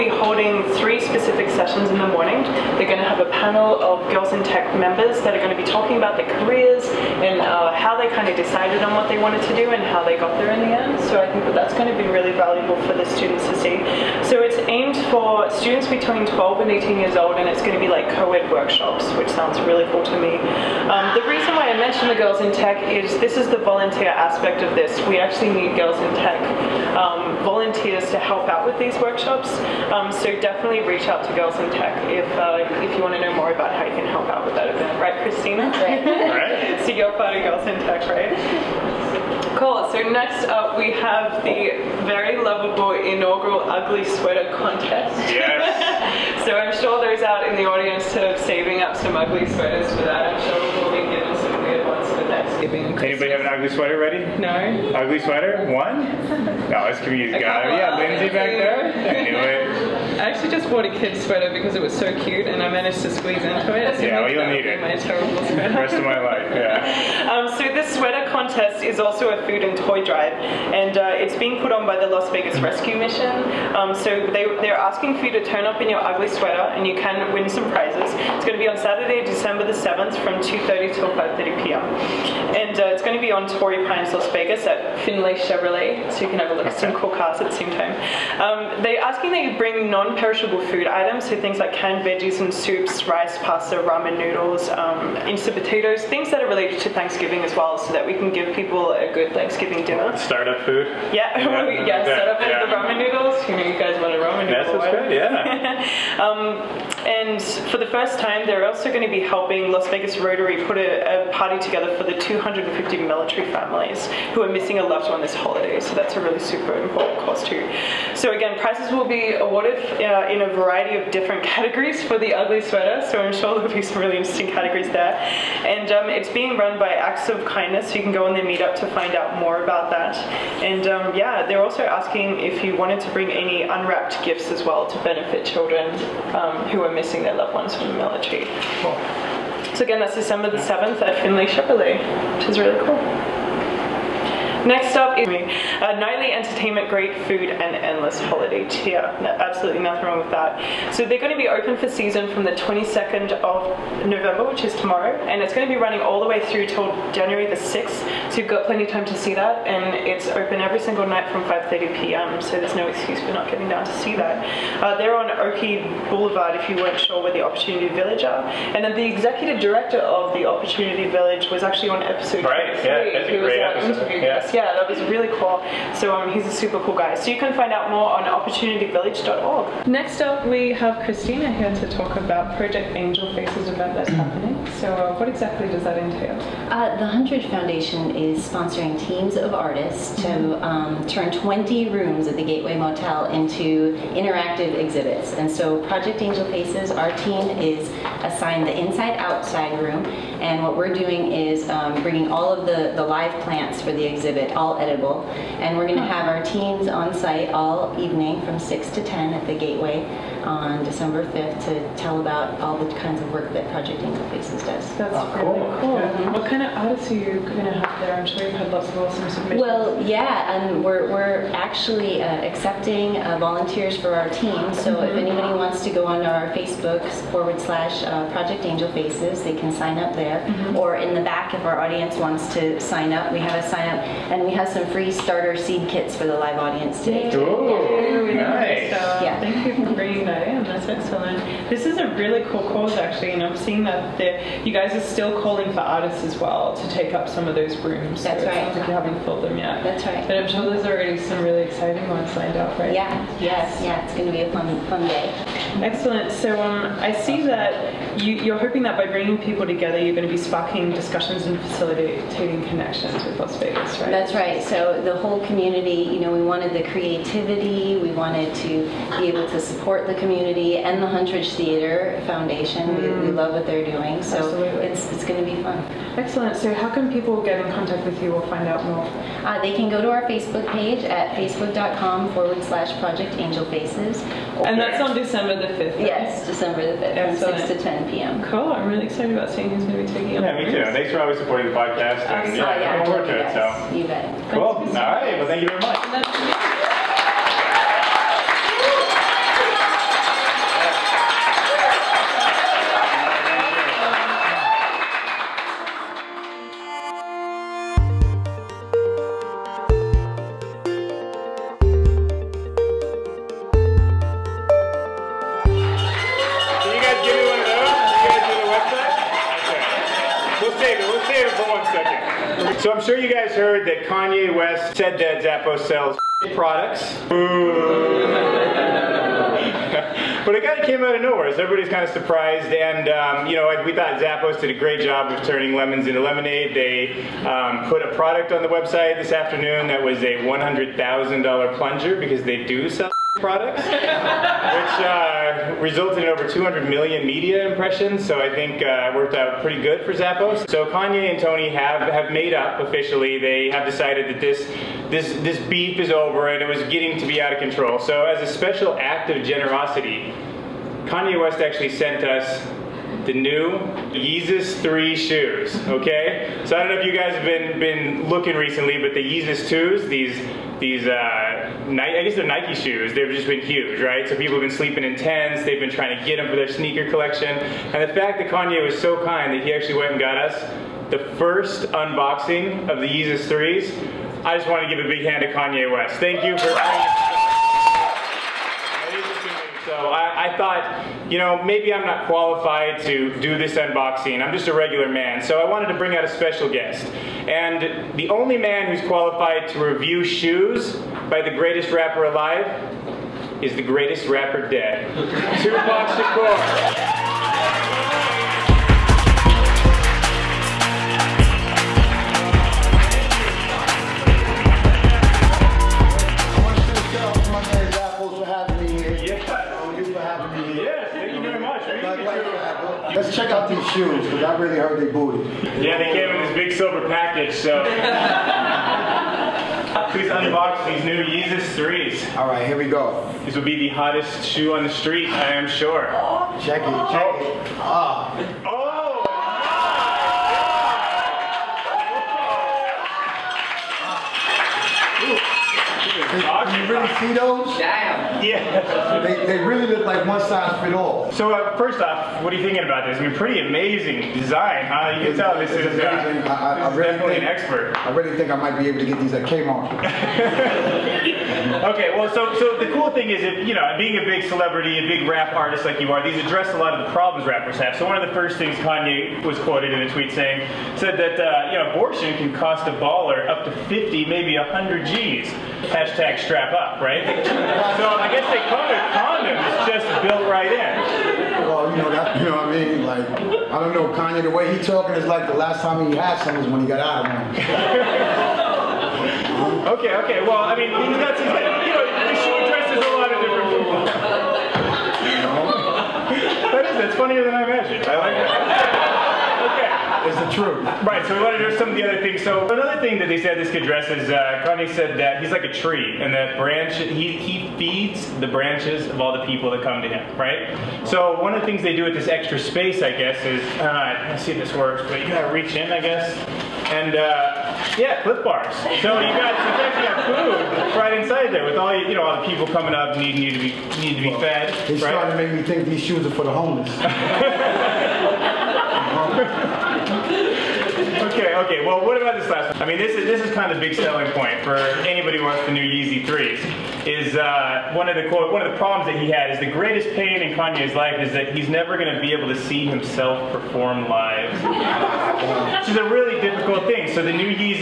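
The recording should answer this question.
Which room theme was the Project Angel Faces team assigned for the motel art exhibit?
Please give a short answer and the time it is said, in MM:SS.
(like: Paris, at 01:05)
inside-outside room, at 03:18.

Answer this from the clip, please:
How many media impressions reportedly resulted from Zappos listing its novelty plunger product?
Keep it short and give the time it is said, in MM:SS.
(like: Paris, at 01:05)
over 200 million, at 05:46.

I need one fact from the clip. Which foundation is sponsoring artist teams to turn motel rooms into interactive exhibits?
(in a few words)
Huntridge Foundation.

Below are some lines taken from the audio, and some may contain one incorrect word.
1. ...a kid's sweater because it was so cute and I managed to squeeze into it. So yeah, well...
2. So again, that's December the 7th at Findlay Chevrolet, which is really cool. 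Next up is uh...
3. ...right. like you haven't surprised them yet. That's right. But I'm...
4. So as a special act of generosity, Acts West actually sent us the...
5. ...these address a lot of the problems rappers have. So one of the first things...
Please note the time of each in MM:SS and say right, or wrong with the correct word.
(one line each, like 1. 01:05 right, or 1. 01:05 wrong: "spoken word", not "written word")
1. 01:00 right
2. 02:19 right
3. 04:08 wrong: "filled", not "surprised"
4. 05:57 wrong: "Kanye", not "Acts"
5. 07:46 right.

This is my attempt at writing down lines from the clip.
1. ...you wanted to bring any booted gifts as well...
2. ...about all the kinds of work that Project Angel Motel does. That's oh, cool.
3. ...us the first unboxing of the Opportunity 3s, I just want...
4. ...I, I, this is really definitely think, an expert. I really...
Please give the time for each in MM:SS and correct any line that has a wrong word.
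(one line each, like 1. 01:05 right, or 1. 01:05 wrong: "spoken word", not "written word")
1. 02:12 wrong: "unwrapped", not "booted"
2. 03:32 wrong: "Faces", not "Motel"
3. 06:20 wrong: "Yeezus", not "Opportunity"
4. 07:36 right.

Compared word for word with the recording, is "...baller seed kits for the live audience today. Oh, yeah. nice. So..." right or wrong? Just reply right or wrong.
wrong.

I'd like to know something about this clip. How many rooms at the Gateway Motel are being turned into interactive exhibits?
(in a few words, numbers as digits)
20.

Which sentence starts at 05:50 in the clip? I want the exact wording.
So Kanye and Tony have have made up officially.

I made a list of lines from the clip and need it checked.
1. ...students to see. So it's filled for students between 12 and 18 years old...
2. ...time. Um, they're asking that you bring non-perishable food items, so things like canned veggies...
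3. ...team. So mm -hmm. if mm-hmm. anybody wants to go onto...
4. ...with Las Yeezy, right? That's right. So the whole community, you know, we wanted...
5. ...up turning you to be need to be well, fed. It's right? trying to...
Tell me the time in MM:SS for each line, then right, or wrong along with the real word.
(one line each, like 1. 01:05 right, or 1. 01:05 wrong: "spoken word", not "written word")
1. 00:13 wrong: "aimed", not "filled"
2. 01:27 right
3. 03:44 right
4. 04:23 wrong: "Vegas", not "Yeezy"
5. 08:42 wrong: "needing", not "turning".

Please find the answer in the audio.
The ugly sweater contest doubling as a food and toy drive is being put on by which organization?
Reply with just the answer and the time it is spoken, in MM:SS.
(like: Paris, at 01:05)
Las Vegas Rescue Mission, at 01:12.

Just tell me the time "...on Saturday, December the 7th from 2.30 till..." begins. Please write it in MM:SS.
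01:18.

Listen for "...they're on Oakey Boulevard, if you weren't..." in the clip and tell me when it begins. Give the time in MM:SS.
02:44.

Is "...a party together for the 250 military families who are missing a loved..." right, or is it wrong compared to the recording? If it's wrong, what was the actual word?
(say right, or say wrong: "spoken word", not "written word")
right.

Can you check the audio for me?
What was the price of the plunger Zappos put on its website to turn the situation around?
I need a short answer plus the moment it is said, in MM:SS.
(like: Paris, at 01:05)
$100,000, at 05:40.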